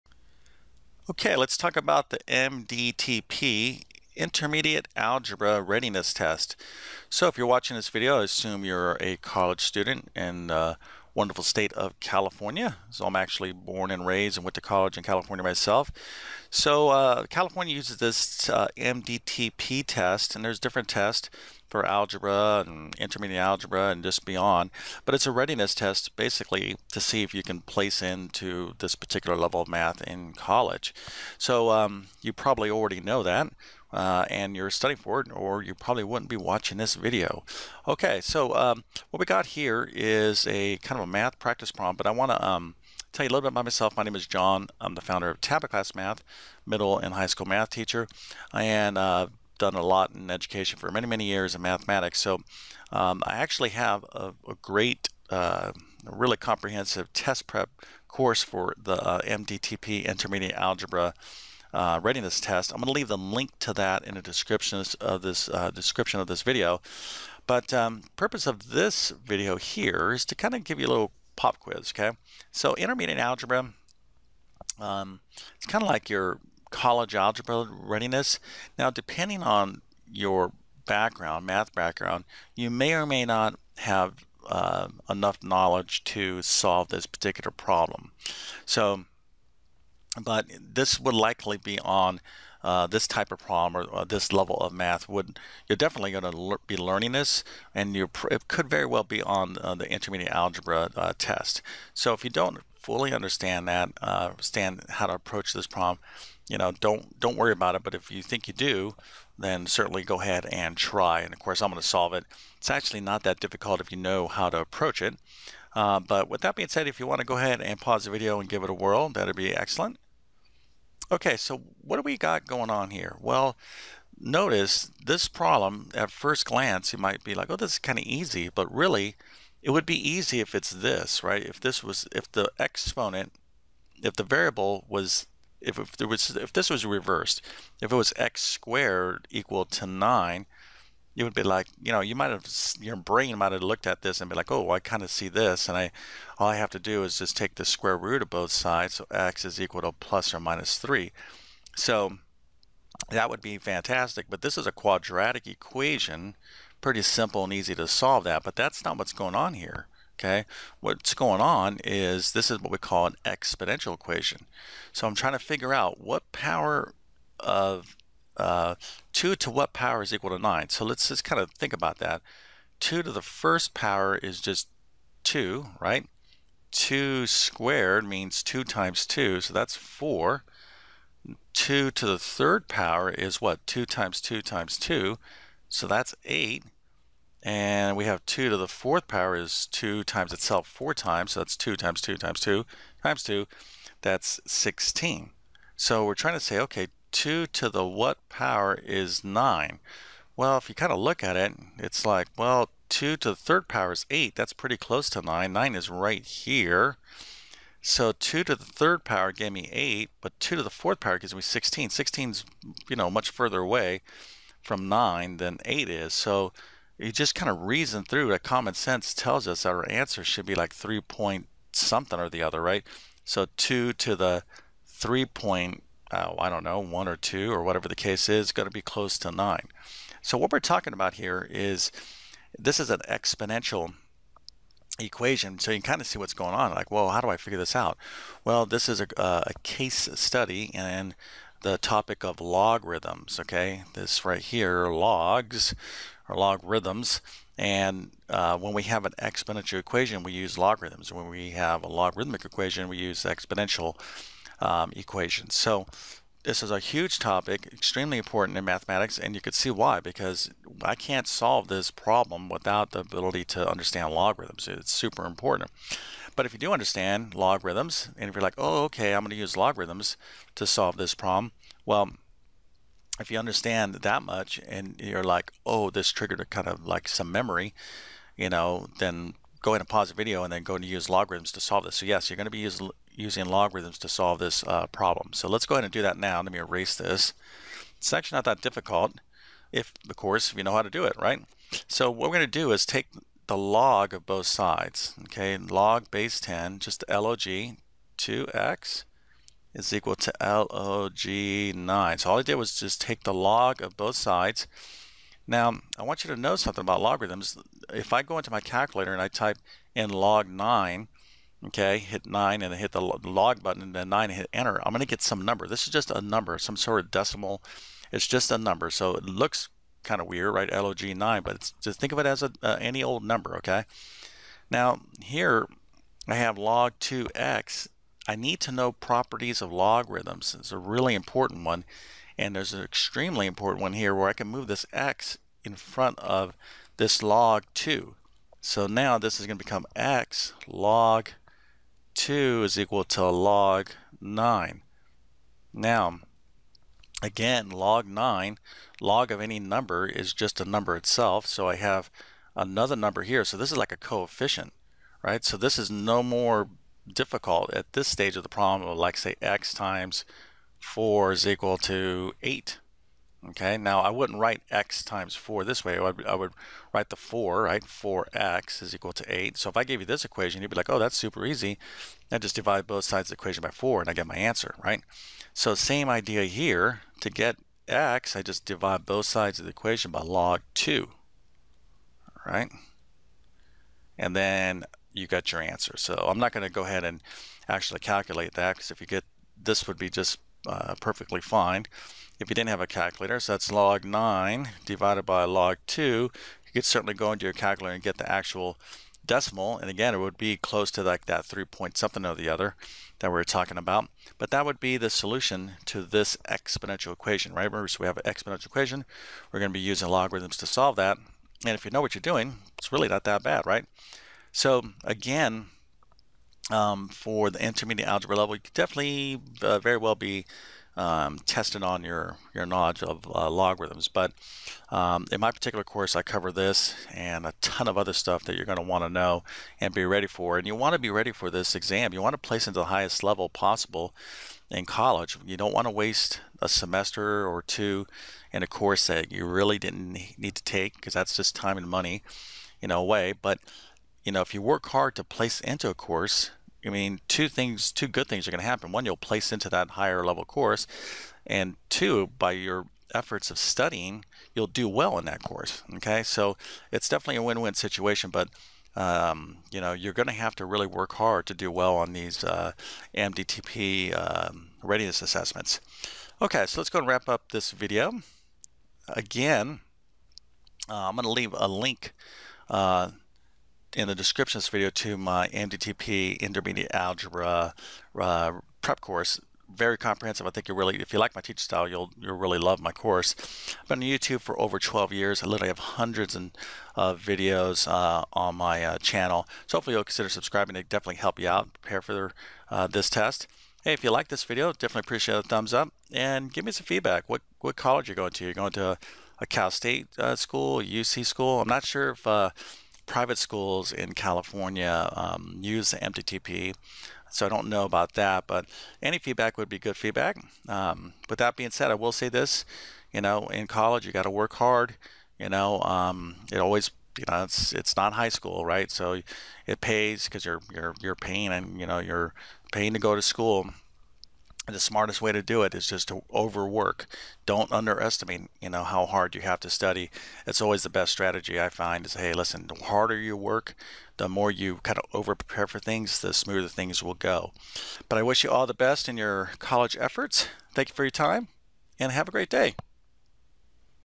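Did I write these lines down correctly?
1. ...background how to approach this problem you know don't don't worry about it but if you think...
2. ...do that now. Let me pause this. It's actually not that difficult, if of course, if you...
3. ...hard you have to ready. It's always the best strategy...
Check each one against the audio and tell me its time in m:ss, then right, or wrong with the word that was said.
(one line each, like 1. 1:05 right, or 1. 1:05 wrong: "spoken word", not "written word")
1. 1:44 wrong: "understand", not "background"
2. 4:45 wrong: "erase", not "pause"
3. 8:49 wrong: "study", not "ready".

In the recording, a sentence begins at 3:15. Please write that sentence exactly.
So we're trying to say, okay, 2 to the what power is 9?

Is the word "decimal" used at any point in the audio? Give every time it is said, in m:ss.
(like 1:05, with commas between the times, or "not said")
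5:17, 6:39.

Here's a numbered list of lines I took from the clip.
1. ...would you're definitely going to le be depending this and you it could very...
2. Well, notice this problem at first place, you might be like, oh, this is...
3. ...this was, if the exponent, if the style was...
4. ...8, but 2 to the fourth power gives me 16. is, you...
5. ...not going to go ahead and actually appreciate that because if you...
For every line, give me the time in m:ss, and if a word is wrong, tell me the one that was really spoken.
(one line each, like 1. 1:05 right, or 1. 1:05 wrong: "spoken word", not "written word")
1. 1:35 wrong: "learning", not "depending"
2. 2:03 wrong: "glance", not "place"
3. 2:11 wrong: "variable", not "style"
4. 3:29 right
5. 6:26 wrong: "calculate", not "appreciate".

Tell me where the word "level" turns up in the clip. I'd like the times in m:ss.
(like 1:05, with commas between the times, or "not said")
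0:29, 1:34, 6:58, 7:13, 7:30.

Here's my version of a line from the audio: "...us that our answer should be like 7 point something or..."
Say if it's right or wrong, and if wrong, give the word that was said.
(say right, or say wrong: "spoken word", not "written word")
wrong: "3", not "7".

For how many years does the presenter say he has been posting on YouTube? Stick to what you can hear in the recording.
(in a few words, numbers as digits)
over 12 years.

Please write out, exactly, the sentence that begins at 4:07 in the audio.
And uh, when we have an exponential equation, we use logarithms.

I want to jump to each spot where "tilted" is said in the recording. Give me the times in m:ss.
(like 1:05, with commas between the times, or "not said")
not said.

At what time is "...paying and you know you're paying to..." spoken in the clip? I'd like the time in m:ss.
8:41.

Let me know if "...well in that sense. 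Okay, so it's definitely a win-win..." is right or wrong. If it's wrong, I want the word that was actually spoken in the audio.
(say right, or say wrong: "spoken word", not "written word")
wrong: "course", not "sense".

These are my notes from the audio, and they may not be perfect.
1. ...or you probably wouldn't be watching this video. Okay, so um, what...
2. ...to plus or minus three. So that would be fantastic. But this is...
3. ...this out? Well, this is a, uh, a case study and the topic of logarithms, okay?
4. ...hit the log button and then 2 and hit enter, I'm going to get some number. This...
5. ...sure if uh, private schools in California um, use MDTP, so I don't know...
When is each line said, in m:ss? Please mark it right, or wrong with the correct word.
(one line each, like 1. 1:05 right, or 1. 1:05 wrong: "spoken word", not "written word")
1. 0:35 right
2. 2:29 right
3. 3:57 right
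4. 5:12 wrong: "9", not "2"
5. 8:21 right.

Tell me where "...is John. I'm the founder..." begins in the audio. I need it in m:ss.
0:44.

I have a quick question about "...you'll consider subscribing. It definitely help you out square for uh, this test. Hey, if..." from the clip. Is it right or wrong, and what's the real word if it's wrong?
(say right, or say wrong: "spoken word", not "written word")
wrong: "prepare", not "square".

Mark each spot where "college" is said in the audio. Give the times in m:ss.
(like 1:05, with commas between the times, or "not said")
0:09, 0:14, 0:30, 1:16, 7:14, 8:17, 8:33, 8:59.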